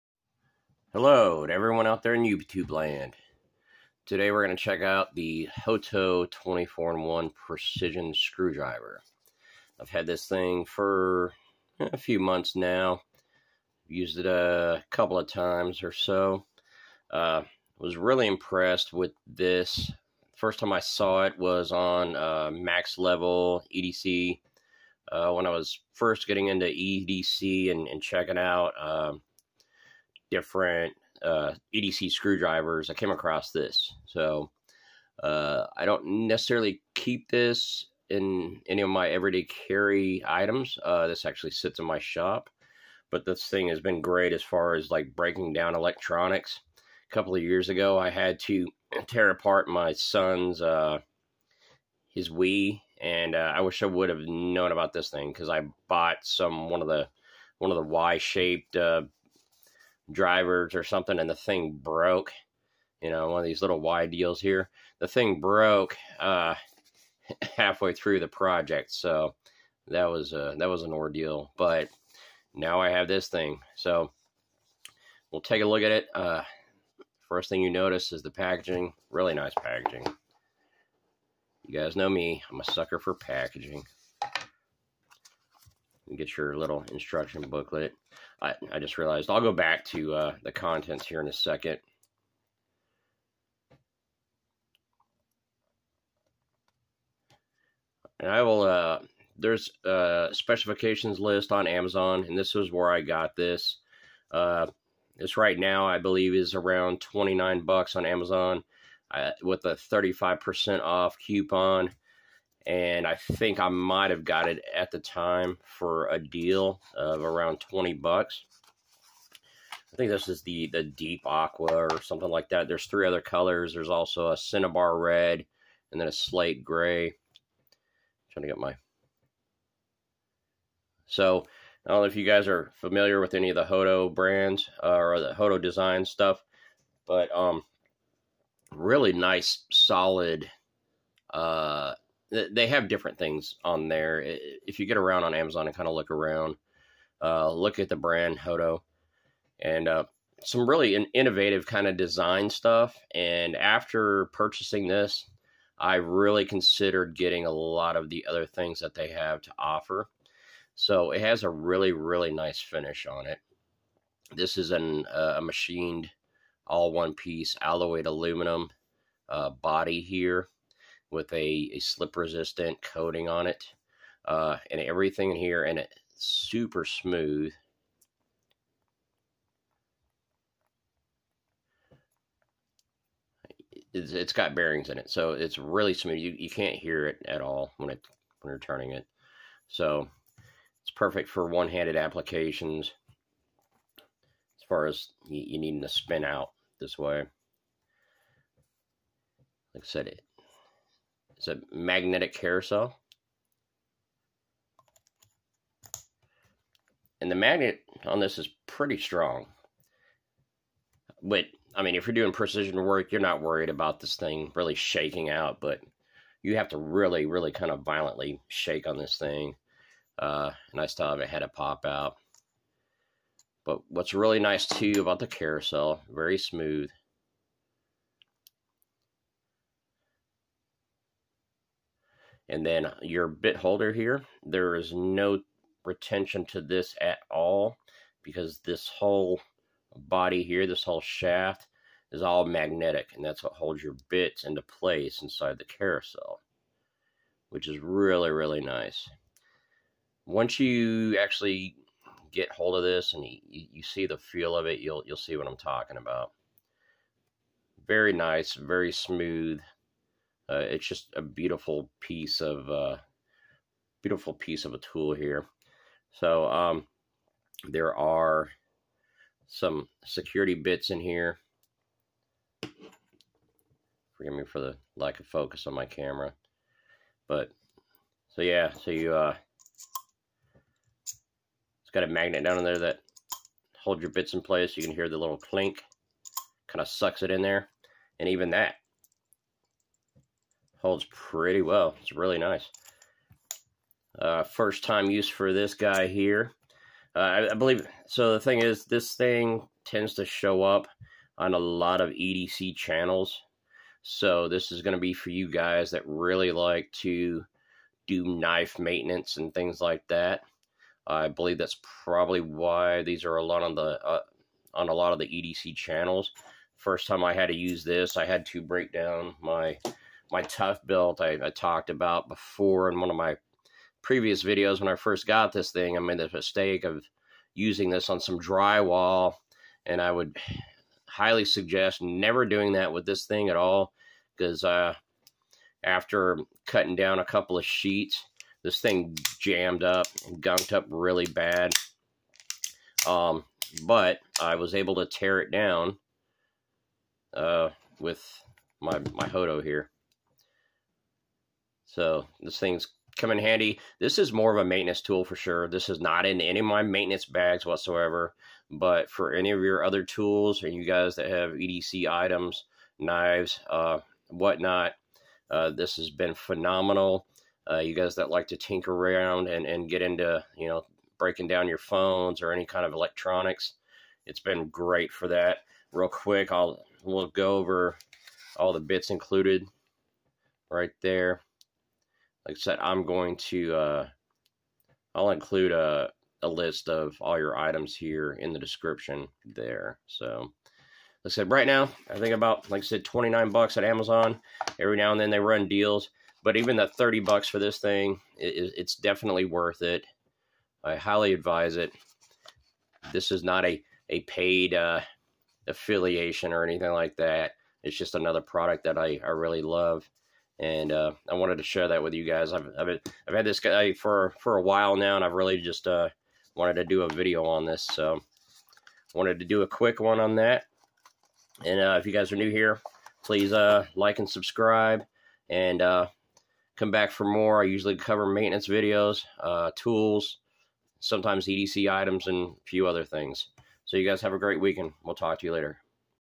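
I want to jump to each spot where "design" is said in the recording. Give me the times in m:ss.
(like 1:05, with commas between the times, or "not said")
2:15, 2:31.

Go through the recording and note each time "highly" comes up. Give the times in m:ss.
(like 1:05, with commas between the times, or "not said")
5:31, 6:40.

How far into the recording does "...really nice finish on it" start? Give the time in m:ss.
2:41.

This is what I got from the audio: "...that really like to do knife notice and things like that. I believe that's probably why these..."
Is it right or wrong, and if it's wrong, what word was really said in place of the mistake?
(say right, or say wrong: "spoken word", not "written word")
wrong: "maintenance", not "notice".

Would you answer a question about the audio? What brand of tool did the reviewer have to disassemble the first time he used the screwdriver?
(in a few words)
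ToughBuilt.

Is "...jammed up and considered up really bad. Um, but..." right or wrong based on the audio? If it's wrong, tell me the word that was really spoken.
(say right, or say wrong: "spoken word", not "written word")
wrong: "gunked", not "considered".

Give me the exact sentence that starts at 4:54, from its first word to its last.
Uh, first time use for this guy here.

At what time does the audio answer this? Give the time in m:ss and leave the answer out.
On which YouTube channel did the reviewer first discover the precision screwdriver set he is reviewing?
0:22.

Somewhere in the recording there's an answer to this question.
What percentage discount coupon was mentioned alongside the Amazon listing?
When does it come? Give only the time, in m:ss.
1:49.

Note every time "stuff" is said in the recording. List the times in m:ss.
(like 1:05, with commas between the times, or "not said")
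2:16, 2:32.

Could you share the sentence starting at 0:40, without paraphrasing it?
Uh, this actually sits in my shop, but this thing has been great as far as like breaking down electronics.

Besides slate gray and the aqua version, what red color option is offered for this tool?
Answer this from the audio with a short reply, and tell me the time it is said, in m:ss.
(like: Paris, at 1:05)
cinnabar red, at 2:04.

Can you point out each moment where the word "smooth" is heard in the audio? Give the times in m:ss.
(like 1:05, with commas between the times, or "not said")
2:56, 3:05, 3:46, 4:18.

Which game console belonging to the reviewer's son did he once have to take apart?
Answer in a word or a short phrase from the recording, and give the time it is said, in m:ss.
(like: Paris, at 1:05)
Wii, at 0:52.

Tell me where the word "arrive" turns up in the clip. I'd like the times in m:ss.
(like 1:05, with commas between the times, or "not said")
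not said.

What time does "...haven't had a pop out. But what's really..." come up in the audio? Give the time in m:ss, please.
3:41.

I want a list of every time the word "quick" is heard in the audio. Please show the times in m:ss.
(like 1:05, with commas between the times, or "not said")
6:16, 6:59.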